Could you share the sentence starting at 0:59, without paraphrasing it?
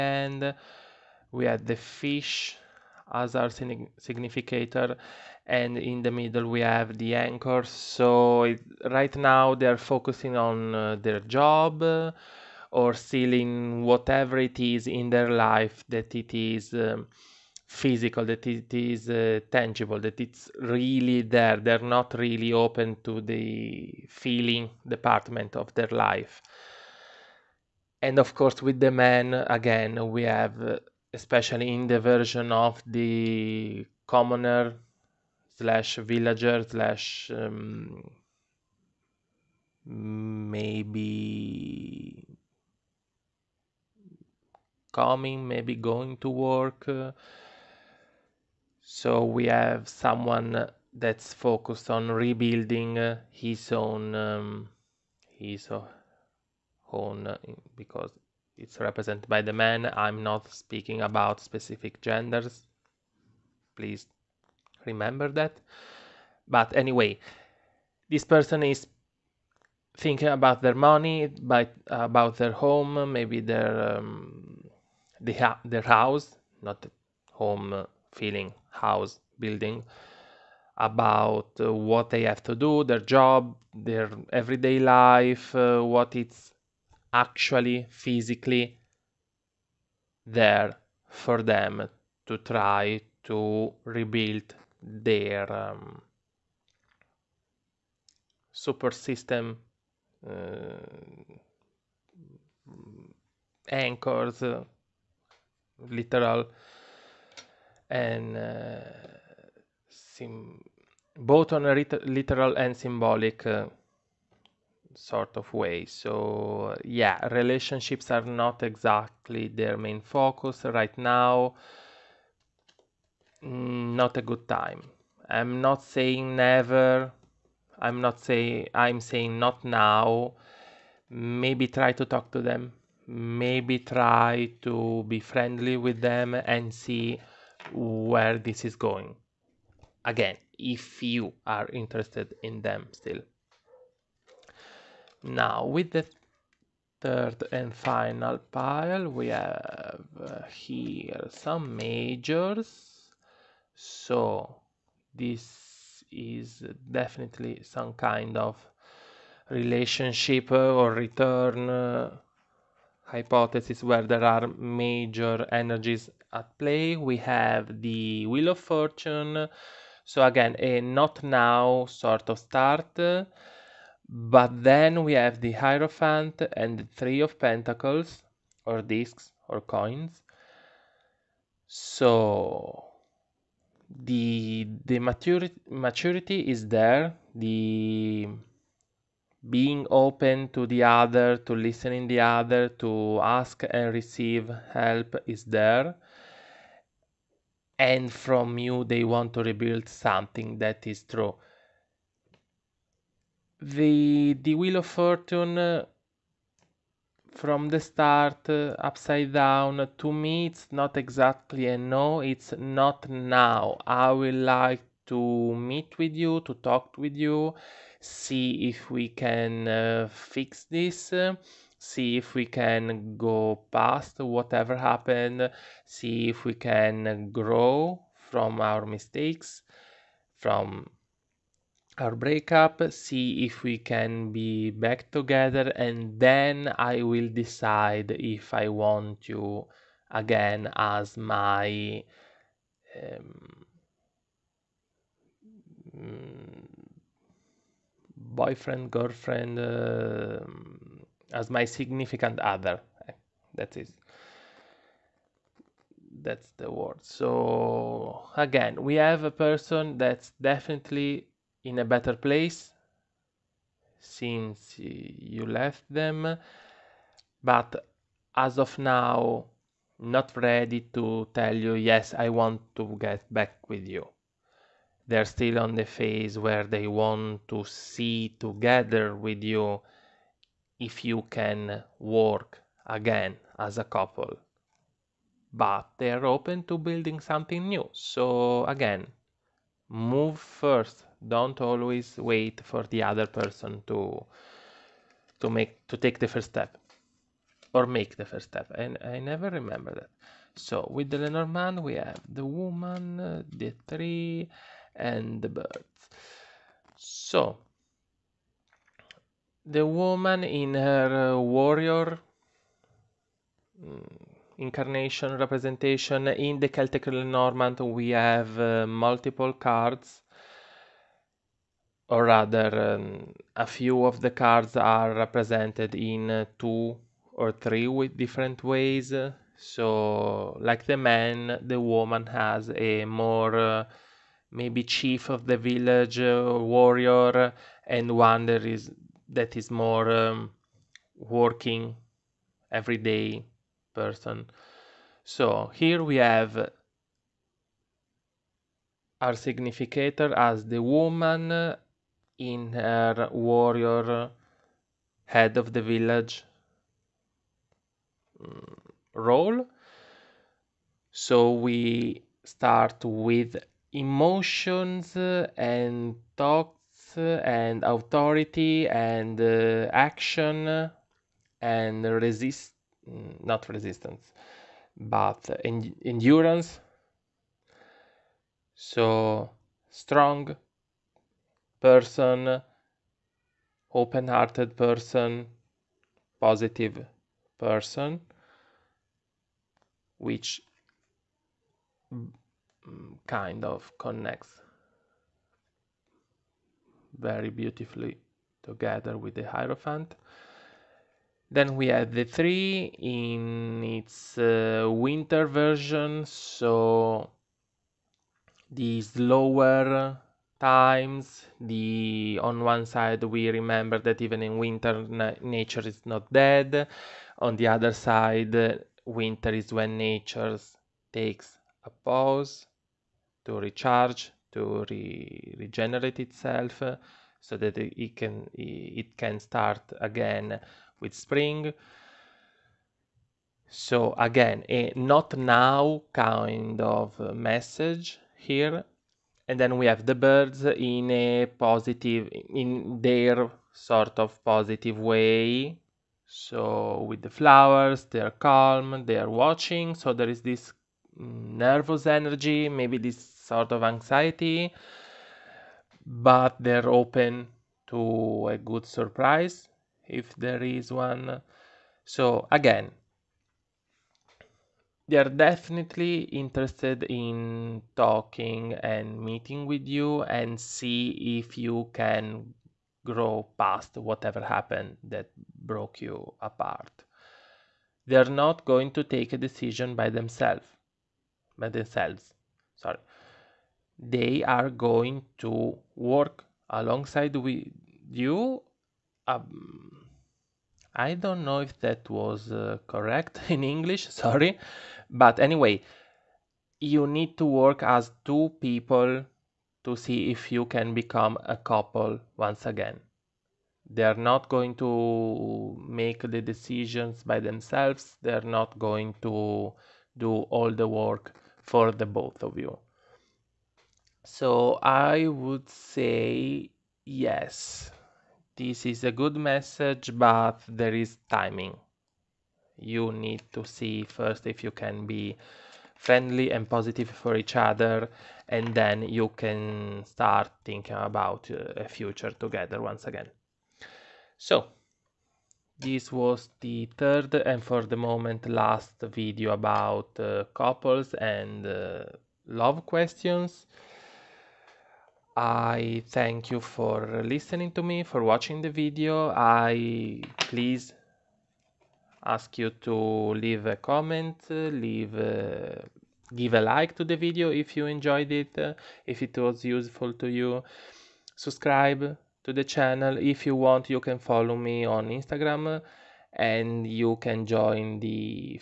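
I'm not speaking about specific genders.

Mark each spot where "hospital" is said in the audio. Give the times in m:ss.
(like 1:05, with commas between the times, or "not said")
not said.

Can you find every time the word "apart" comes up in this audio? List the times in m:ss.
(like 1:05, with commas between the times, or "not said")
7:56.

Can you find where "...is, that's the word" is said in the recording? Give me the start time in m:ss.
4:13.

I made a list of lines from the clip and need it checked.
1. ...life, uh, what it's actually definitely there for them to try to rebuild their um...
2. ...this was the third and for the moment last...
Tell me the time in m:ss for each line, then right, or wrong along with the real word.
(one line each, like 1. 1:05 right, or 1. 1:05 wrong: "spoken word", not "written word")
1. 1:24 wrong: "physically", not "definitely"
2. 8:55 right.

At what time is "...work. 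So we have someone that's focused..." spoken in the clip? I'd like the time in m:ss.
0:46.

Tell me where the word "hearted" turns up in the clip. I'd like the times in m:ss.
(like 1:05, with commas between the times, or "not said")
6:23.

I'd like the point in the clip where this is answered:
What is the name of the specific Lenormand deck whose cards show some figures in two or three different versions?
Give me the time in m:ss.
5:16.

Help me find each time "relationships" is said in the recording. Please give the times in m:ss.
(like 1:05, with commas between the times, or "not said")
1:57, 2:39.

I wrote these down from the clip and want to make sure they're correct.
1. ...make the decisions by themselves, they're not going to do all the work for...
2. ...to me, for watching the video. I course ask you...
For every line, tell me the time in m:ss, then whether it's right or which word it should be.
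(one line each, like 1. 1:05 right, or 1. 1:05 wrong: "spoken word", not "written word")
1. 8:25 right
2. 9:07 wrong: "please", not "course".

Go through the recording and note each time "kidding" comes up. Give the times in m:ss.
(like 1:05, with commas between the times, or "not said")
not said.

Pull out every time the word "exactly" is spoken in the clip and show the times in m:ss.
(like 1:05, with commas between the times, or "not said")
1:58, 3:30.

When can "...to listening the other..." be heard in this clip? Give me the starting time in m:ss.
3:11.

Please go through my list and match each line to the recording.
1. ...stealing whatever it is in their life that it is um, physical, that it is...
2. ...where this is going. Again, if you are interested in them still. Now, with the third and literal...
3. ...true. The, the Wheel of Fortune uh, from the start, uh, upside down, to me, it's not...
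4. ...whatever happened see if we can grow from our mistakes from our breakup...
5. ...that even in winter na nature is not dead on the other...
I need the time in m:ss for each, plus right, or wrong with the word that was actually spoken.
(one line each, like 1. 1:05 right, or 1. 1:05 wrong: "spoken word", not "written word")
1. 0:12 right
2. 2:17 wrong: "final", not "literal"
3. 3:21 right
4. 3:44 right
5. 6:53 right.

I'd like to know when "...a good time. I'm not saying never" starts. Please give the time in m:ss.
2:04.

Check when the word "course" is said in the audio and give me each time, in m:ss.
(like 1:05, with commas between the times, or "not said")
0:28.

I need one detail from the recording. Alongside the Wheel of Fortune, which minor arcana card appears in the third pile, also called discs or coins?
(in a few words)
Three of Pentacles.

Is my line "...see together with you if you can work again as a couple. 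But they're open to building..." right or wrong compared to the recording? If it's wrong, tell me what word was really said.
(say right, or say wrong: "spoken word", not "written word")
right.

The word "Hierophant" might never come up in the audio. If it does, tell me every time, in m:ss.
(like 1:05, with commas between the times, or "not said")
2:55, 6:39.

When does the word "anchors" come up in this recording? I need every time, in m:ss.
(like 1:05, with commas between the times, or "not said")
0:07, 1:43.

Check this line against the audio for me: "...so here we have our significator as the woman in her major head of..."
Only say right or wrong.
wrong.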